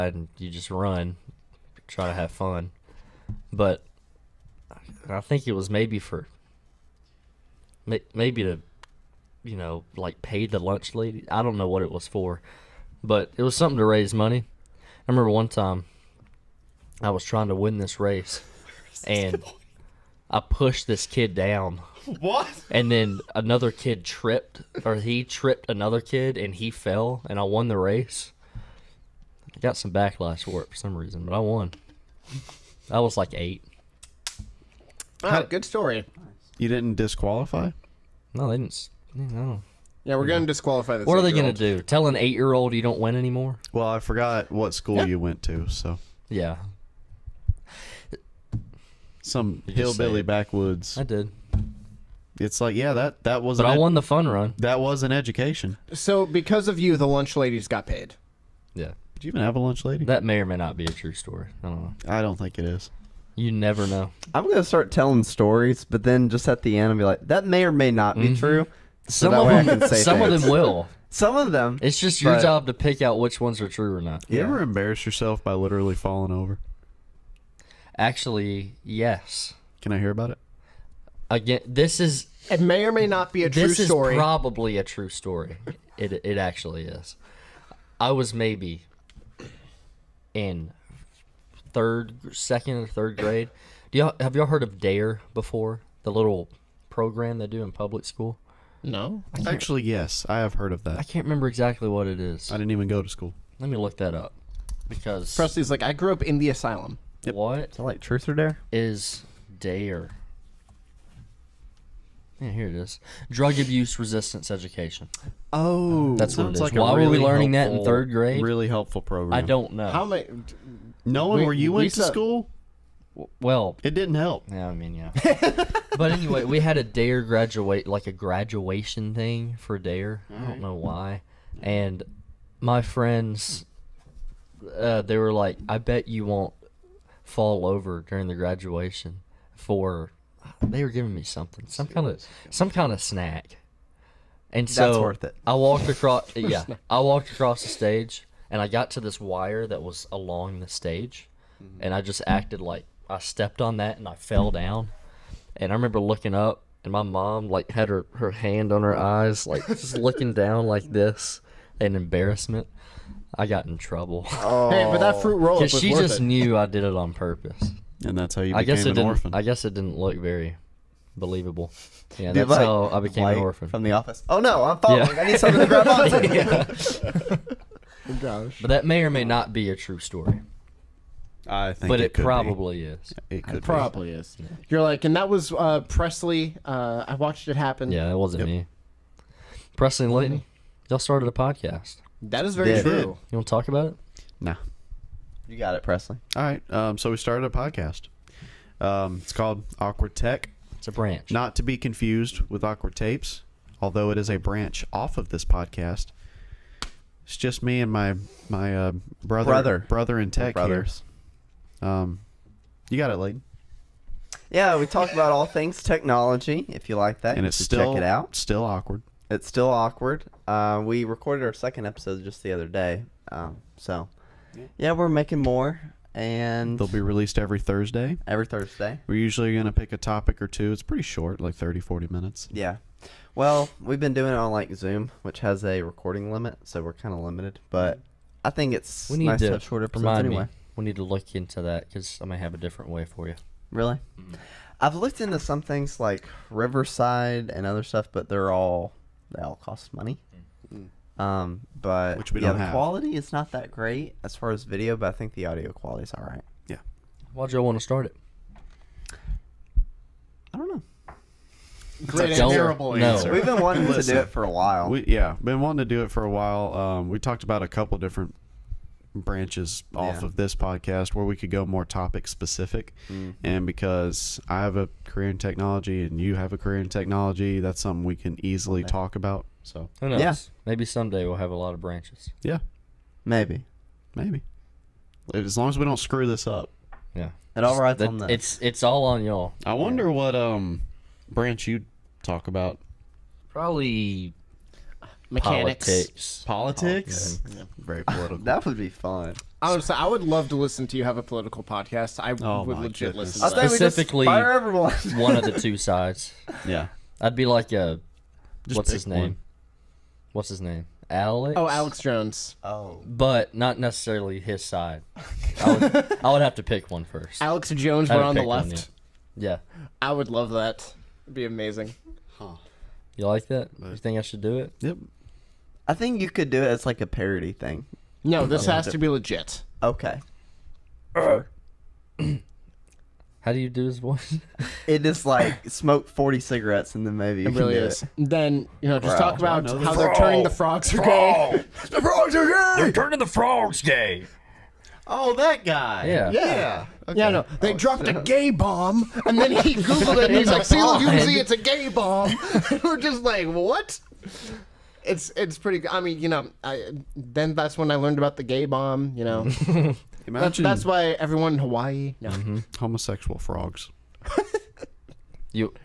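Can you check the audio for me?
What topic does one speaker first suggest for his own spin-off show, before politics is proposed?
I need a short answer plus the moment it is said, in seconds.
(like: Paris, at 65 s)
Mechanics, at 295 s.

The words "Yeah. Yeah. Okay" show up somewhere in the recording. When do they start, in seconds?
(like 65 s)
346 s.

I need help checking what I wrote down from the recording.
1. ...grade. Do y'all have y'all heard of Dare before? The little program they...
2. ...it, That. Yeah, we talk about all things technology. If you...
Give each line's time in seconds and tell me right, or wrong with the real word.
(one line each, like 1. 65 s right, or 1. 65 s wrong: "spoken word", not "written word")
1. 93 s right
2. 213 s wrong: "Layton", not "That".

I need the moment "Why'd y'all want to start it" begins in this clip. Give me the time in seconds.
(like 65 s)
257 s.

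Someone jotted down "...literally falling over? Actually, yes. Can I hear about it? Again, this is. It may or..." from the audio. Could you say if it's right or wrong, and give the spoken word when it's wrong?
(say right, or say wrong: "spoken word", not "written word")
right.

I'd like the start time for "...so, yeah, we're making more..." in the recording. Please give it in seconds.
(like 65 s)
223 s.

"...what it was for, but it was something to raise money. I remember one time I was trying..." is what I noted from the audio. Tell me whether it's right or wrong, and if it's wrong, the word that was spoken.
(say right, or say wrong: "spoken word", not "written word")
right.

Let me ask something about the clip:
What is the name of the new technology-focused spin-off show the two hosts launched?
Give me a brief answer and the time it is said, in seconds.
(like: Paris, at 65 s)
Awkward Tech, at 199 s.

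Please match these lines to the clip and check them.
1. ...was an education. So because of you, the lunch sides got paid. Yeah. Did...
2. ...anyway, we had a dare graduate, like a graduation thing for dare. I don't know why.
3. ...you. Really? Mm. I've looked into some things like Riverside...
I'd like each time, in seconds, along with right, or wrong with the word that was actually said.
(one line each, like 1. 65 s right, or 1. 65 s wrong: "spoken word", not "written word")
1. 54 s wrong: "ladies", not "sides"
2. 126 s right
3. 243 s right.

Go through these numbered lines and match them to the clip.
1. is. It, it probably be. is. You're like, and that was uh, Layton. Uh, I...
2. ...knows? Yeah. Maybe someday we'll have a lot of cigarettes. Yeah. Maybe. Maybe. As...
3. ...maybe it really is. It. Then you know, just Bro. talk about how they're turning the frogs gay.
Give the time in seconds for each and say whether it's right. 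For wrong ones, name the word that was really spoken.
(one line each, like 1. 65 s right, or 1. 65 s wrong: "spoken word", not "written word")
1. 182 s wrong: "Presley", not "Layton"
2. 280 s wrong: "branches", not "cigarettes"
3. 337 s right.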